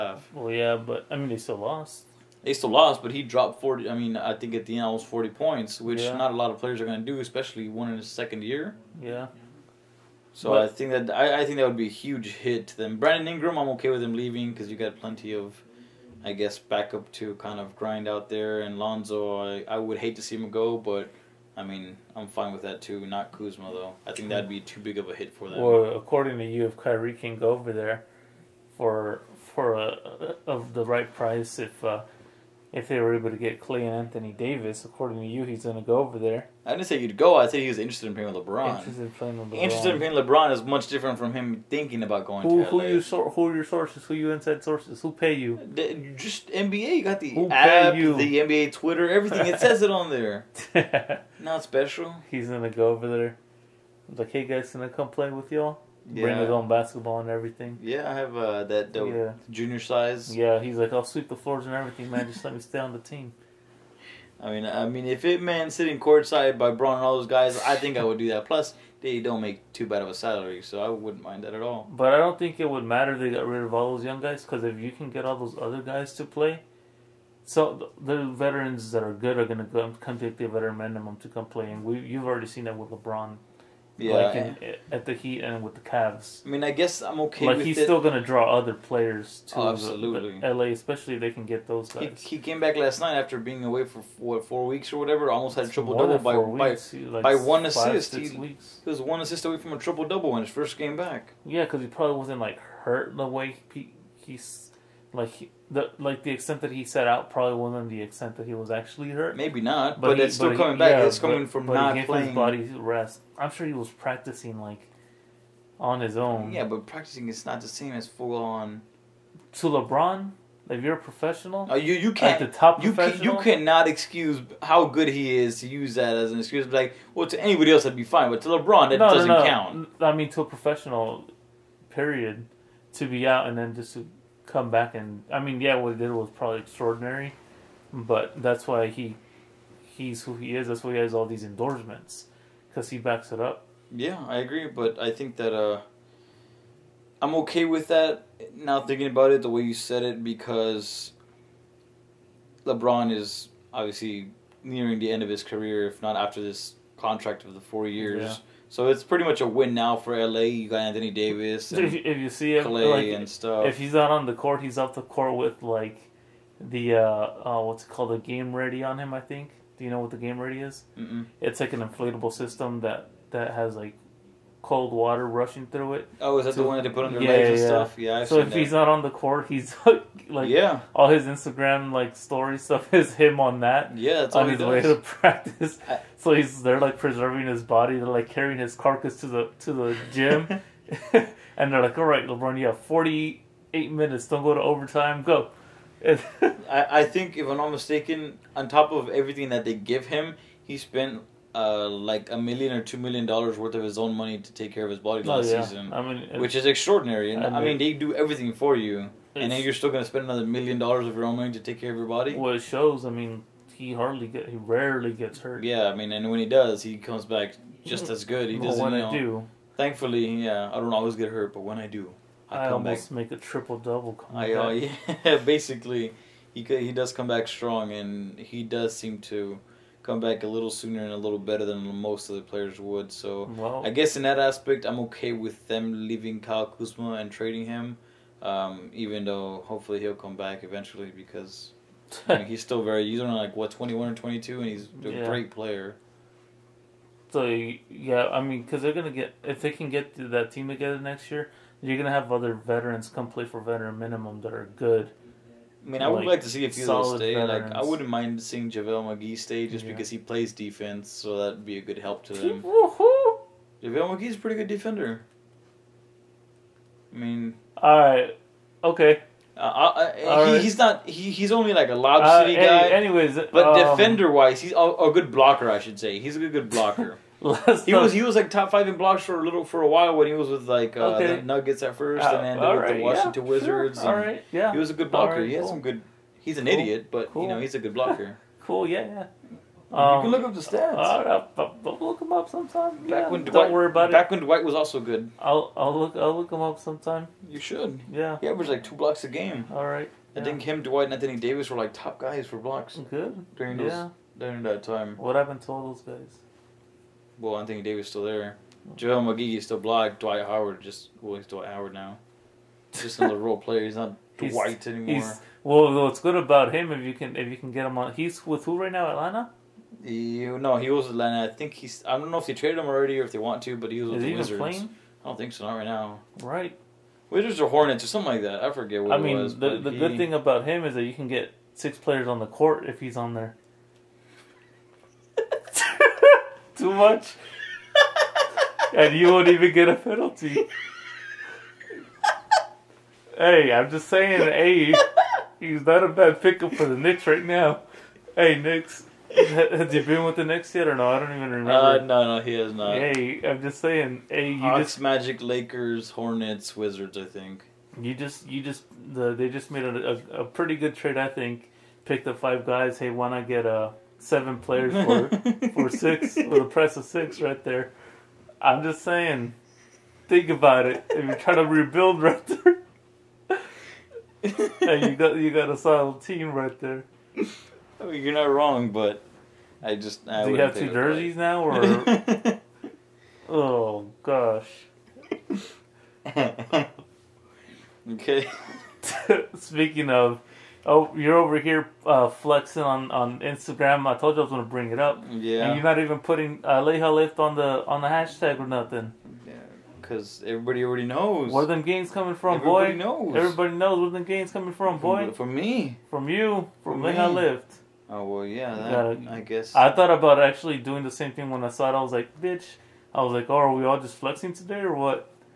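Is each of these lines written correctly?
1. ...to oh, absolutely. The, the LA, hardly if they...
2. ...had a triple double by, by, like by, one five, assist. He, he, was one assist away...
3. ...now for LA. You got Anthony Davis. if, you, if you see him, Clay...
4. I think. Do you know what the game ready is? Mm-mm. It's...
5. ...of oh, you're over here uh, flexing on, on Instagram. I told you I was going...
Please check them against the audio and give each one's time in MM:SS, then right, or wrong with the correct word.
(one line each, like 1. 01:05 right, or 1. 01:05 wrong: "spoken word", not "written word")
1. 01:29 wrong: "especially", not "hardly"
2. 01:35 right
3. 02:39 right
4. 02:49 right
5. 06:30 right.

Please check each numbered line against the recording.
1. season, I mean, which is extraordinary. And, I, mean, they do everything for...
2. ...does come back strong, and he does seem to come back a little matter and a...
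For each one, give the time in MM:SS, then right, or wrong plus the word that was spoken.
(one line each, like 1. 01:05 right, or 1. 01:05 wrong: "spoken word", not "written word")
1. 03:25 right
2. 03:46 wrong: "sooner", not "matter".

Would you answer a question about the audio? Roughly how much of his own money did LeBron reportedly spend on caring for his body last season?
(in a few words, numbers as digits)
1 or 2 million dollars.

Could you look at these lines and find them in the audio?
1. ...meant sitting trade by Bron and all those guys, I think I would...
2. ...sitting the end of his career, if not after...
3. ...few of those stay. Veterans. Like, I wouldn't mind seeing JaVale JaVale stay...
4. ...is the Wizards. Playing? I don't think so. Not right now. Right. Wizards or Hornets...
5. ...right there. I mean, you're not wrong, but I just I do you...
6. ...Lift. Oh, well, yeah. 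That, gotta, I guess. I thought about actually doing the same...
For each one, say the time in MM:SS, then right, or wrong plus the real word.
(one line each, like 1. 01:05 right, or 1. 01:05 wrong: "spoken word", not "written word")
1. 01:05 wrong: "courtside", not "trade"
2. 02:34 wrong: "nearing", not "sitting"
3. 04:16 wrong: "McGee", not "JaVale"
4. 05:24 right
5. 06:16 right
6. 06:47 right.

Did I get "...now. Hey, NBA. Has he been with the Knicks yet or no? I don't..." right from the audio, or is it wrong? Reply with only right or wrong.
wrong.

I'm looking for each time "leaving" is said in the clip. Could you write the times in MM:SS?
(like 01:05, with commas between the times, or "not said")
00:14, 03:56.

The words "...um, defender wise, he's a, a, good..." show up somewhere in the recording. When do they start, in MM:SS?
04:33.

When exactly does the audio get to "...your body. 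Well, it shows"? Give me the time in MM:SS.
03:31.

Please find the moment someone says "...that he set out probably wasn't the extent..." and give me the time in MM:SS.
01:46.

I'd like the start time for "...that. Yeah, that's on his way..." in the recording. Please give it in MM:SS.
03:03.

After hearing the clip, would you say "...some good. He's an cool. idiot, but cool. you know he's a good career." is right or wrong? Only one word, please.
wrong.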